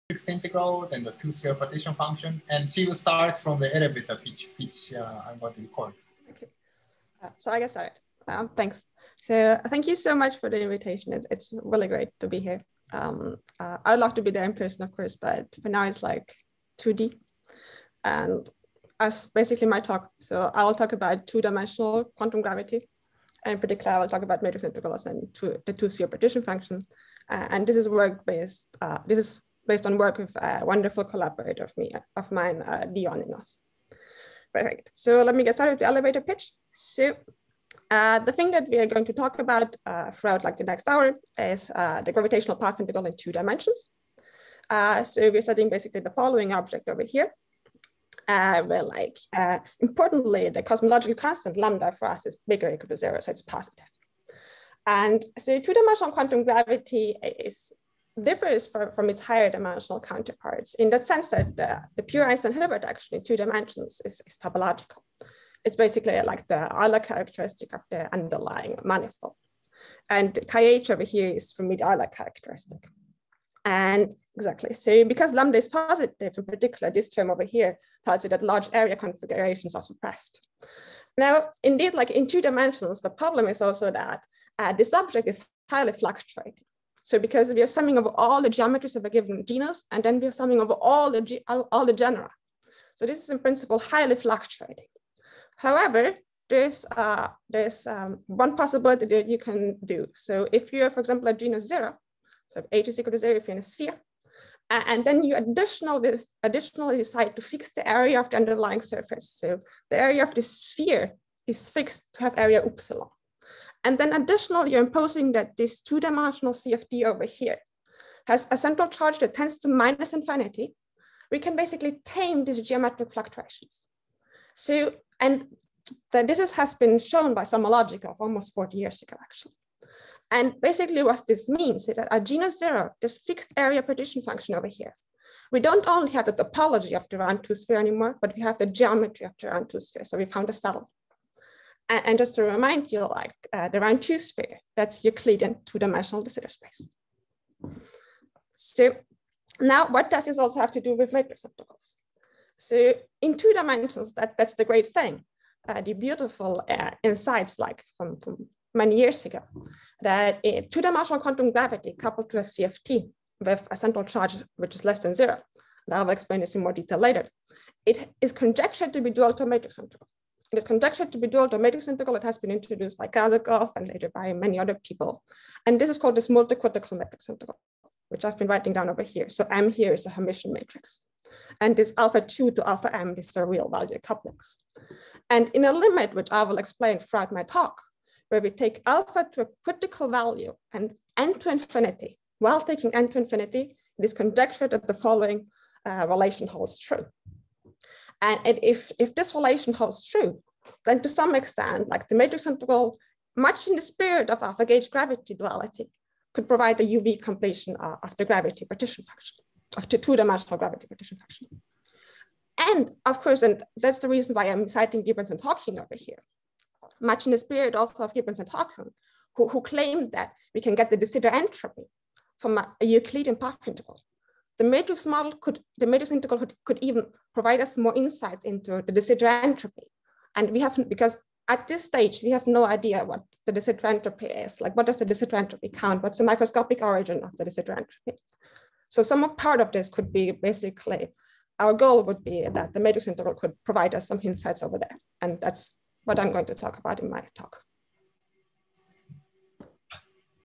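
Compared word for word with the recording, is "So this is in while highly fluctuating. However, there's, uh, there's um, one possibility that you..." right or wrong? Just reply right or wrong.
wrong.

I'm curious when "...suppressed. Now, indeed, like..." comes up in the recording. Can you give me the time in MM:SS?
01:19.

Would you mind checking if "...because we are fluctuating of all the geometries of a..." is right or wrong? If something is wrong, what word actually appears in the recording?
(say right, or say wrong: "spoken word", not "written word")
wrong: "summing", not "fluctuating".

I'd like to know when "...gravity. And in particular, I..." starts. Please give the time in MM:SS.
00:22.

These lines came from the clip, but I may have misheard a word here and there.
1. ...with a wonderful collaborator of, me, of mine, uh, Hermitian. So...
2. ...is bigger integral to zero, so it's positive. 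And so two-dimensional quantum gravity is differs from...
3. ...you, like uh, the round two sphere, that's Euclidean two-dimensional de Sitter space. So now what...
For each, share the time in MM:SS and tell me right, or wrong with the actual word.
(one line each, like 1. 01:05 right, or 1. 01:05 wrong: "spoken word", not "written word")
1. 00:30 wrong: "Perfect", not "Hermitian"
2. 00:52 wrong: "equal", not "integral"
3. 02:22 right.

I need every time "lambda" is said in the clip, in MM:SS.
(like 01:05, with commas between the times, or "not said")
00:51, 01:15.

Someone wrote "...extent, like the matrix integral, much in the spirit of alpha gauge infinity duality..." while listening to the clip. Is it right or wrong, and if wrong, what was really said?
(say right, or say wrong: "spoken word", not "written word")
wrong: "gravity", not "infinity".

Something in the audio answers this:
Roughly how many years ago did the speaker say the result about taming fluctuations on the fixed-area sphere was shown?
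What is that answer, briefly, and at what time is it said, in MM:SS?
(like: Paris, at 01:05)
40, at 02:08.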